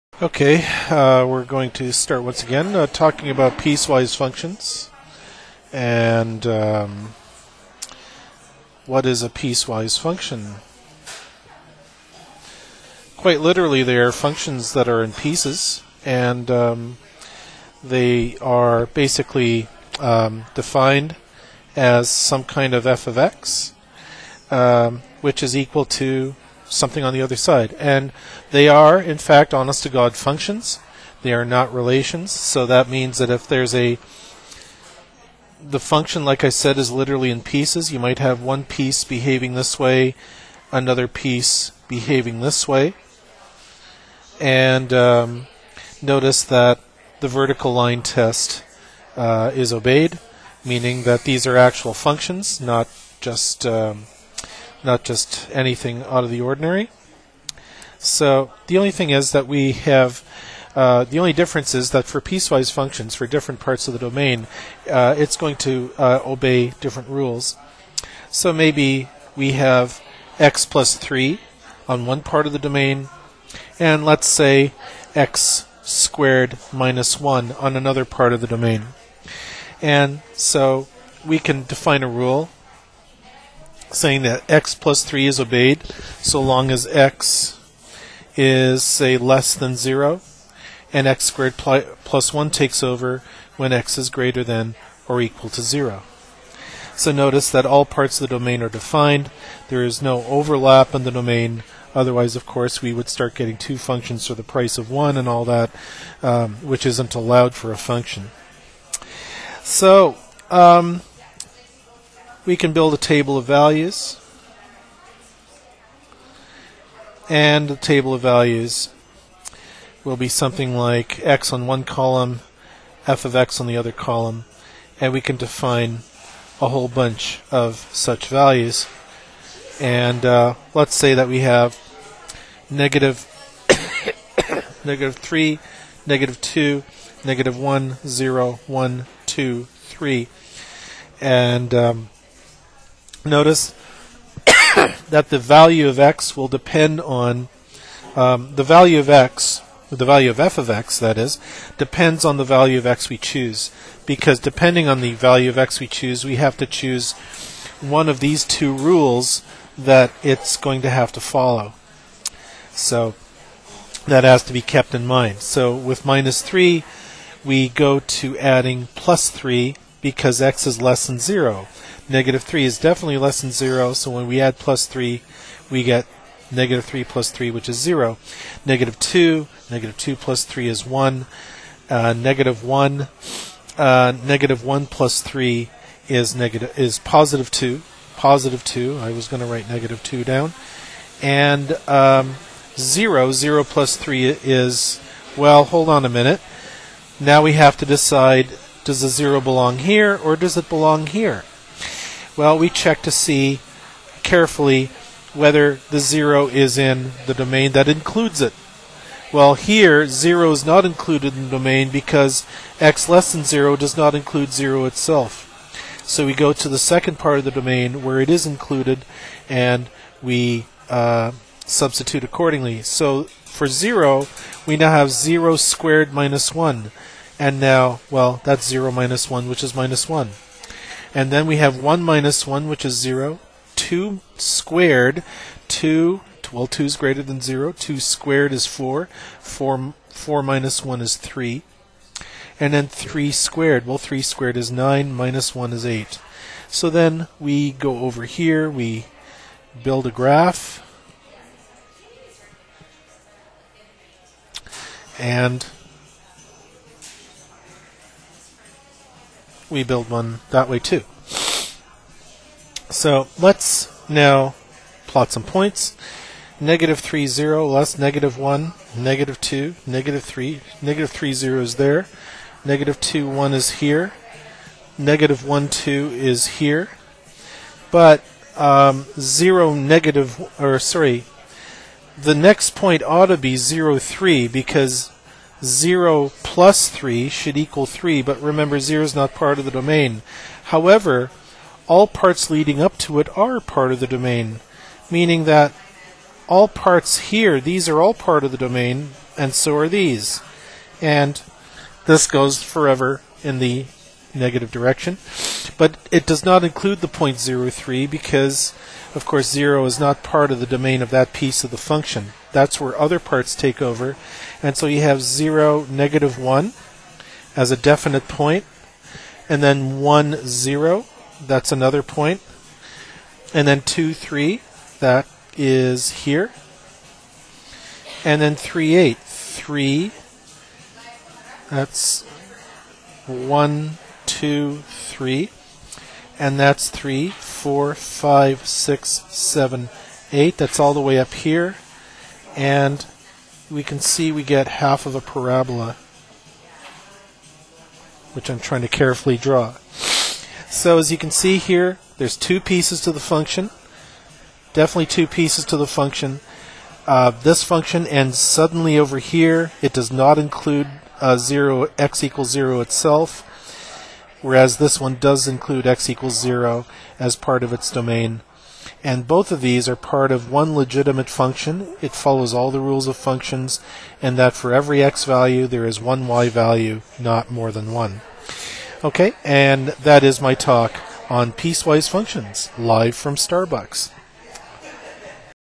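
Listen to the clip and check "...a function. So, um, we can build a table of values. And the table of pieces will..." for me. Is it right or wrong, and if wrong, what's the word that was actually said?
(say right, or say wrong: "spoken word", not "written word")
wrong: "values", not "pieces".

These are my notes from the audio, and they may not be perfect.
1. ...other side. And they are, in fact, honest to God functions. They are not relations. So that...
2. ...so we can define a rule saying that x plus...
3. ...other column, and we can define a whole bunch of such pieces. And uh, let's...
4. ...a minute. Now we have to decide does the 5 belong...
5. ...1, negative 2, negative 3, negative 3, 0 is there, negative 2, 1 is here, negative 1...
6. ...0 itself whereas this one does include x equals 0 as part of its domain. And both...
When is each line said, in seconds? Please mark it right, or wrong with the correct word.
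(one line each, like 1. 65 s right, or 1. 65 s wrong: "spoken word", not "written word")
1. 27 s right
2. 80 s right
3. 123 s wrong: "values", not "pieces"
4. 196 s wrong: "0", not "5"
5. 268 s right
6. 362 s right.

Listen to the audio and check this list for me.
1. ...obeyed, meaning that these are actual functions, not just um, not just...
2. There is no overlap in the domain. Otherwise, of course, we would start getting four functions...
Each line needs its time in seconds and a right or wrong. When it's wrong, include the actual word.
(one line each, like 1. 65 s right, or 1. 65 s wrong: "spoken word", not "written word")
1. 49 s right
2. 99 s wrong: "two", not "four".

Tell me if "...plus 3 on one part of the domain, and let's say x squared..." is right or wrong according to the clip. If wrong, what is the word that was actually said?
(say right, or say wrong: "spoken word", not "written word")
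right.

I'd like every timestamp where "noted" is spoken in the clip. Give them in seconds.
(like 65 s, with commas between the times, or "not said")
not said.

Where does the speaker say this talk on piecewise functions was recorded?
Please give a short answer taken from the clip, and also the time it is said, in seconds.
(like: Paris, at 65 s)
Starbucks, at 383 s.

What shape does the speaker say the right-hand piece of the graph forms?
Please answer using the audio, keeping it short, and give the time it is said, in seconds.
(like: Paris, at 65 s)
half of a parabola, at 344 s.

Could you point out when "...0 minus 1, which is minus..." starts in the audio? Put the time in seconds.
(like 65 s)
228 s.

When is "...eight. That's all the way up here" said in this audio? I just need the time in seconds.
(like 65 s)
340 s.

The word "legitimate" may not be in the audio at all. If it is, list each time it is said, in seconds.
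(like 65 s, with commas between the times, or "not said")
370 s.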